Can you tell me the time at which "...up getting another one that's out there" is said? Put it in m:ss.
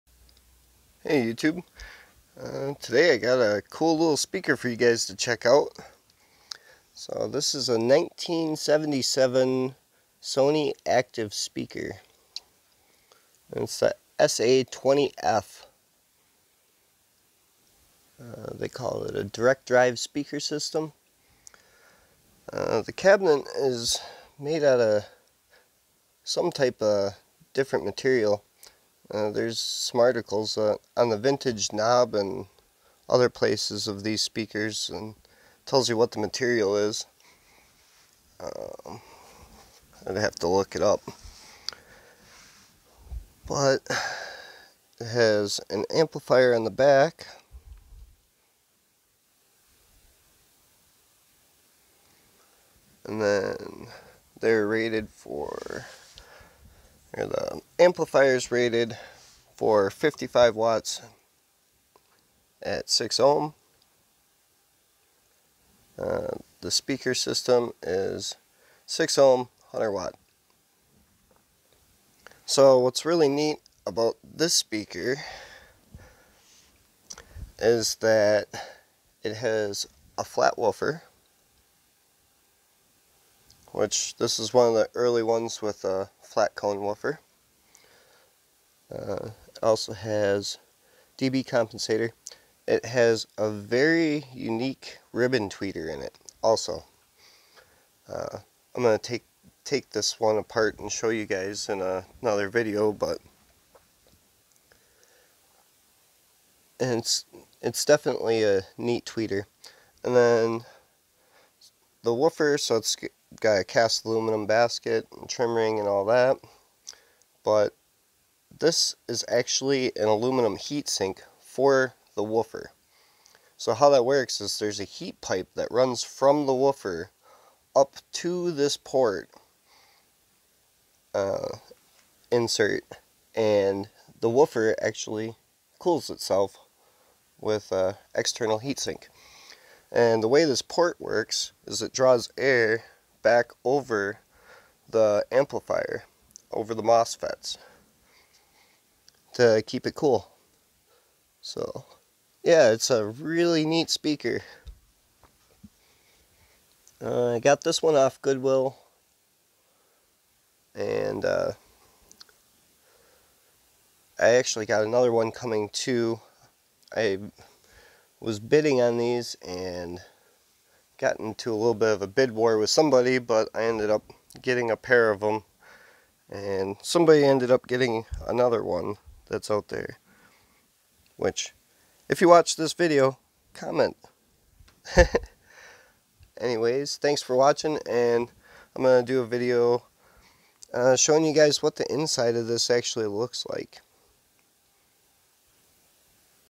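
2:57.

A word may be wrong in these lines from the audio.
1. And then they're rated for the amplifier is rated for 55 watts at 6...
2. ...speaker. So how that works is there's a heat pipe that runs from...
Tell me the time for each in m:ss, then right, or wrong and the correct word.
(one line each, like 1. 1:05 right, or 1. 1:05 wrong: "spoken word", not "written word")
1. 0:53 right
2. 2:02 wrong: "woofer", not "speaker".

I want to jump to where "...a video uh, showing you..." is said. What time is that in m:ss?
3:09.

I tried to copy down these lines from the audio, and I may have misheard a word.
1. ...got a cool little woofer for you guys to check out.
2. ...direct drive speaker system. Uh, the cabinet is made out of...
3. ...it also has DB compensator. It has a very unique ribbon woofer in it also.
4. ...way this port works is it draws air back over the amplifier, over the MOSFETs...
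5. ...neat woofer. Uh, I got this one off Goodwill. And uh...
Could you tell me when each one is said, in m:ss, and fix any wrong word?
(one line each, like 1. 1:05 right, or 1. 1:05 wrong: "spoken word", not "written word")
1. 0:03 wrong: "speaker", not "woofer"
2. 0:19 right
3. 1:29 wrong: "tweeter", not "woofer"
4. 2:20 right
5. 2:33 wrong: "speaker", not "woofer".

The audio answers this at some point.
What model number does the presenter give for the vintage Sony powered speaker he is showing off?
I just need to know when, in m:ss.
0:14.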